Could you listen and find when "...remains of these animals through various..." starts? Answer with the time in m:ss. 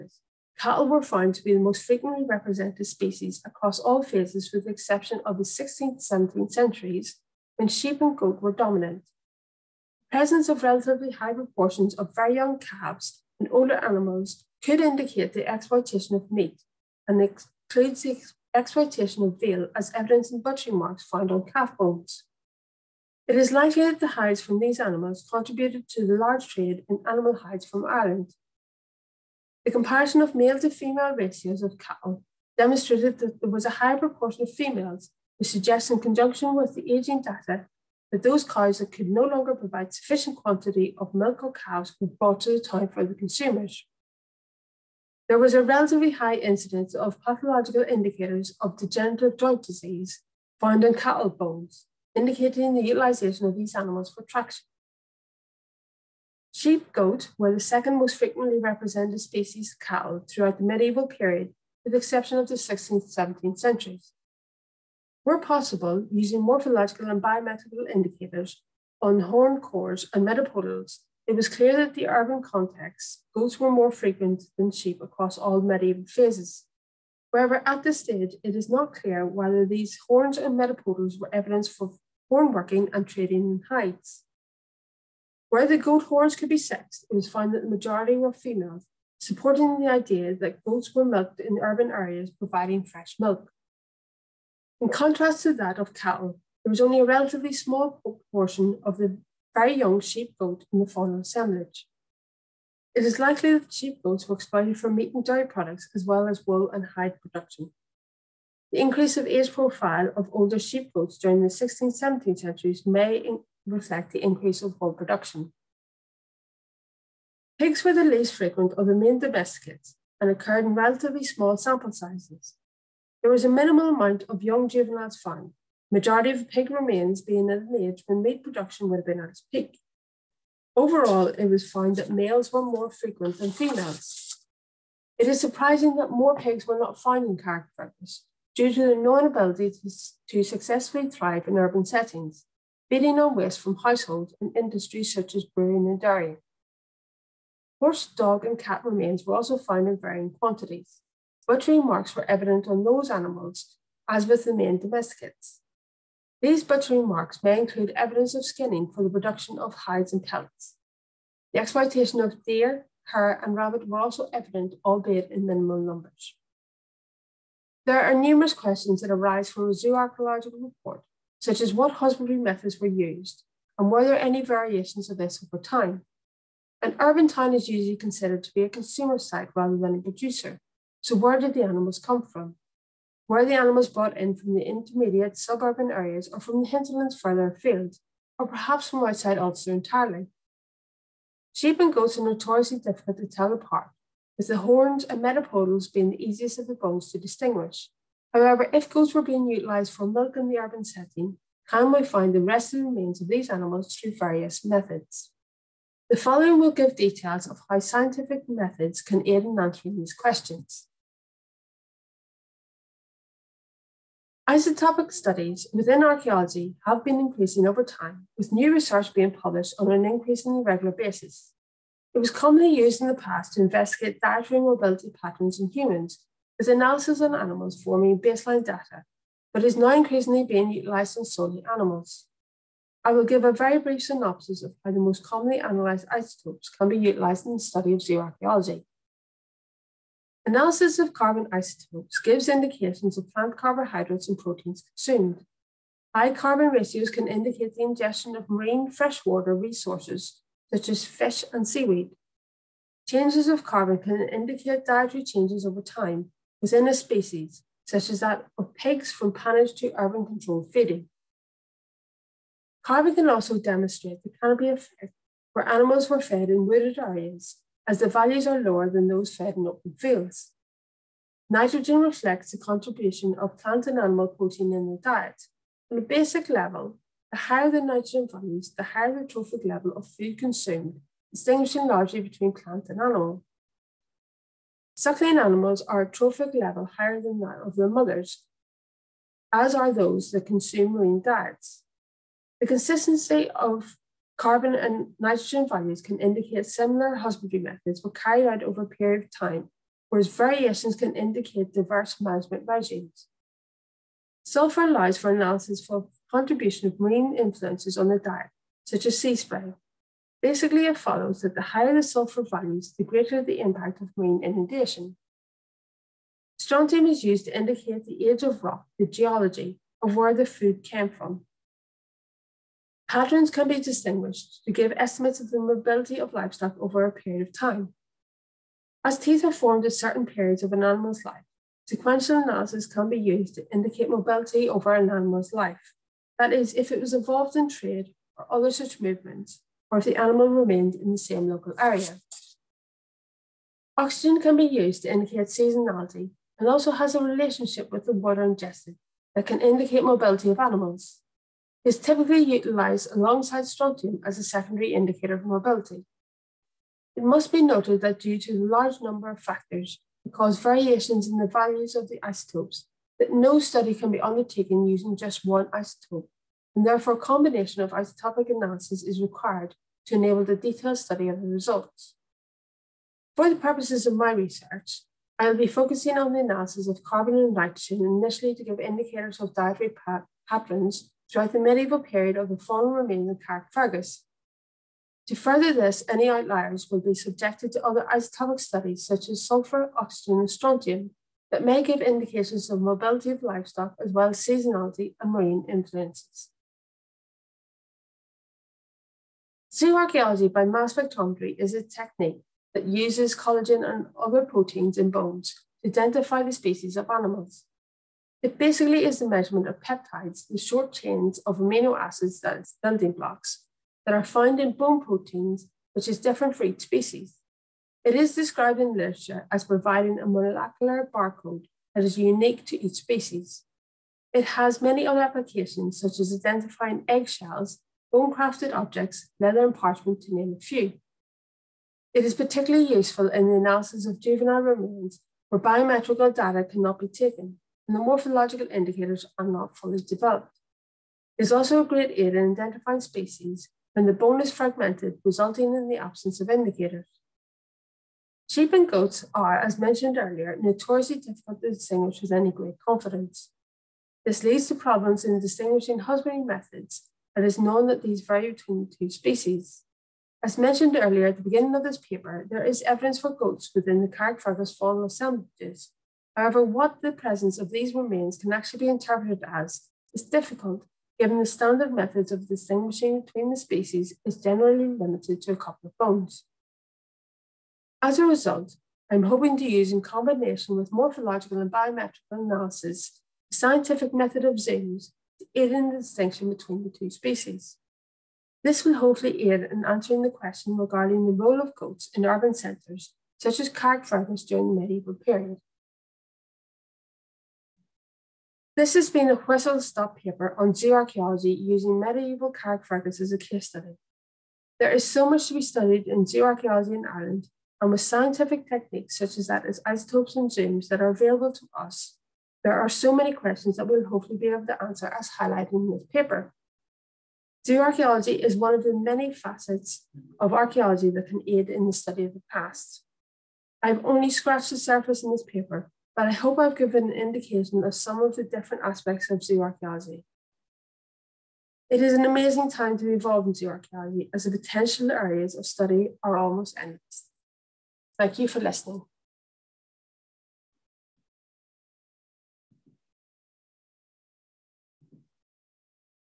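3:22.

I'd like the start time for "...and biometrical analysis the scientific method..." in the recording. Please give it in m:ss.
8:01.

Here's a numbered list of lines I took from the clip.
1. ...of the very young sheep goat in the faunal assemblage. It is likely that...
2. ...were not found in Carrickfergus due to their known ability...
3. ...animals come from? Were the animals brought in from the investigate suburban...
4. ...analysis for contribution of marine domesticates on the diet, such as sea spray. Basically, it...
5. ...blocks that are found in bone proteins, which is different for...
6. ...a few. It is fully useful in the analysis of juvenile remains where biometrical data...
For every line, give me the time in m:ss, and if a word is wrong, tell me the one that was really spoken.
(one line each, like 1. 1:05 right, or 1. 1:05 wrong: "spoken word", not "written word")
1. 1:38 right
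2. 2:16 right
3. 3:01 wrong: "intermediate", not "investigate"
4. 5:05 wrong: "influences", not "domesticates"
5. 6:53 right
6. 7:10 wrong: "particularly", not "fully".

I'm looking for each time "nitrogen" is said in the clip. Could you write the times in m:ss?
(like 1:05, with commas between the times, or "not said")
4:31, 4:37, 4:55, 6:17.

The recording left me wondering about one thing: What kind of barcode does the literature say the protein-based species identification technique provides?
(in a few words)
Molecular barcode.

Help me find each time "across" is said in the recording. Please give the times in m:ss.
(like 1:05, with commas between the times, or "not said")
0:03, 1:15.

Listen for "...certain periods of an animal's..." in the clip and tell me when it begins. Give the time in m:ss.
5:29.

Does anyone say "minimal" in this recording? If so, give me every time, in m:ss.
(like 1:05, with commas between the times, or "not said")
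2:03, 2:45.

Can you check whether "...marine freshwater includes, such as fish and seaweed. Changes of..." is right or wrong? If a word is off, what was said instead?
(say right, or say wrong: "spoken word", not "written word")
wrong: "resources", not "includes".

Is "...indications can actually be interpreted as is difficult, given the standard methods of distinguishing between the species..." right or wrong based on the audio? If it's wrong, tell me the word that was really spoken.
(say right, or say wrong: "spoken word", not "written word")
wrong: "remains", not "indications".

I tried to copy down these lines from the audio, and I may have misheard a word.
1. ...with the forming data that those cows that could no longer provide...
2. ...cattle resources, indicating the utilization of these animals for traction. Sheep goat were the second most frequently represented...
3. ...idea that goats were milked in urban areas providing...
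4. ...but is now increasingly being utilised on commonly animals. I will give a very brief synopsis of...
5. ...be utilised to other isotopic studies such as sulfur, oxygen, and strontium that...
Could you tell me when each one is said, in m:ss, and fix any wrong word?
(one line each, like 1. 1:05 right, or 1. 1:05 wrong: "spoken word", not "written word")
1. 0:36 wrong: "aging", not "forming"
2. 0:50 wrong: "bones", not "resources"
3. 1:29 right
4. 3:49 wrong: "solely", not "commonly"
5. 6:26 wrong: "subjected", not "utilised".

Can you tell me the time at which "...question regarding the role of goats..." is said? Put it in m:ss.
8:10.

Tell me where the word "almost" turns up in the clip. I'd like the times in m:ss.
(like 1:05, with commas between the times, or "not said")
8:56.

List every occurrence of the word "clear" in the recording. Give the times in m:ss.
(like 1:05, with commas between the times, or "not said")
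1:11, 1:18.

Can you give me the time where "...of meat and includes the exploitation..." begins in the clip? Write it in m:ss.
0:16.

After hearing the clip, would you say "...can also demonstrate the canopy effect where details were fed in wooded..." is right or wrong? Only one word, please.
wrong.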